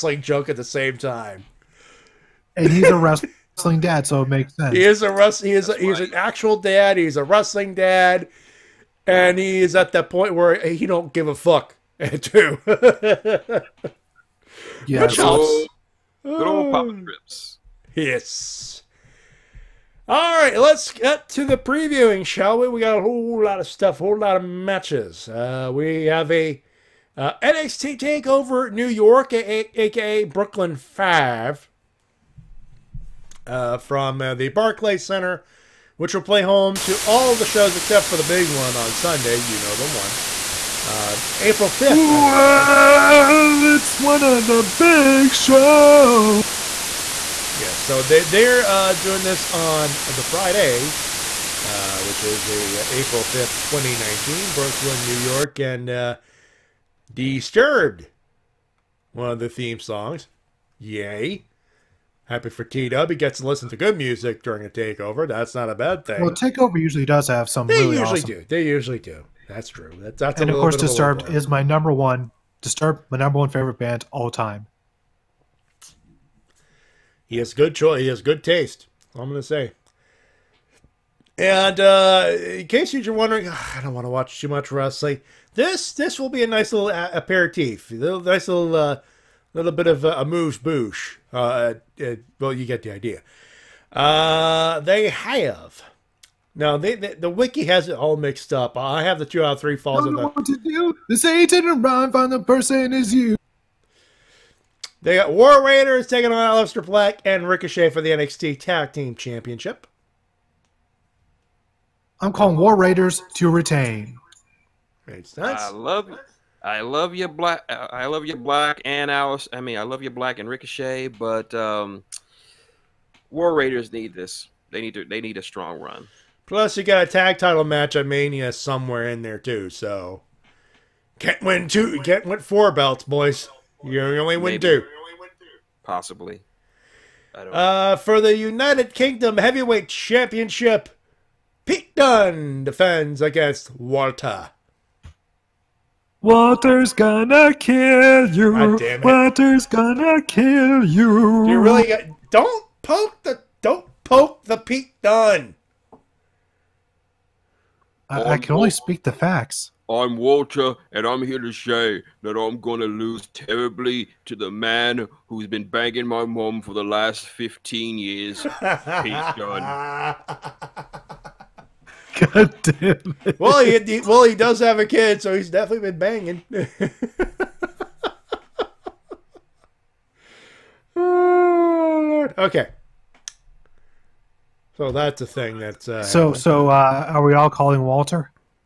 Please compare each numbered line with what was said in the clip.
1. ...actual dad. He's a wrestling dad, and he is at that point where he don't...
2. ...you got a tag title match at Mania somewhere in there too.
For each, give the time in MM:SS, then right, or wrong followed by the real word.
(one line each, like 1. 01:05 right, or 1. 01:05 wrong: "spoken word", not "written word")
1. 00:06 right
2. 02:06 right.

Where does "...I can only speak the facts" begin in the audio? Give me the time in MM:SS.
02:38.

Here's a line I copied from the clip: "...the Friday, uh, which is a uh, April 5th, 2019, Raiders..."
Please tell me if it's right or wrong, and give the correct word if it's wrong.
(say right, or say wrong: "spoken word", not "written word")
wrong: "Brooklyn", not "Raiders".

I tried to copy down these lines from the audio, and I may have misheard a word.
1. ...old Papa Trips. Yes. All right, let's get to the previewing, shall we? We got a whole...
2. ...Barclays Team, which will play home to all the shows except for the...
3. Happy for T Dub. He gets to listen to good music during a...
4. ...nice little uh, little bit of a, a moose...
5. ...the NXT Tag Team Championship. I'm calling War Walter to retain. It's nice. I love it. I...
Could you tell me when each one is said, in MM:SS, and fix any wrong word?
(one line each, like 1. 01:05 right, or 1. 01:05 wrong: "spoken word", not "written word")
1. 00:16 right
2. 00:34 wrong: "Center", not "Team"
3. 01:02 right
4. 01:28 right
5. 01:48 wrong: "Raiders", not "Walter".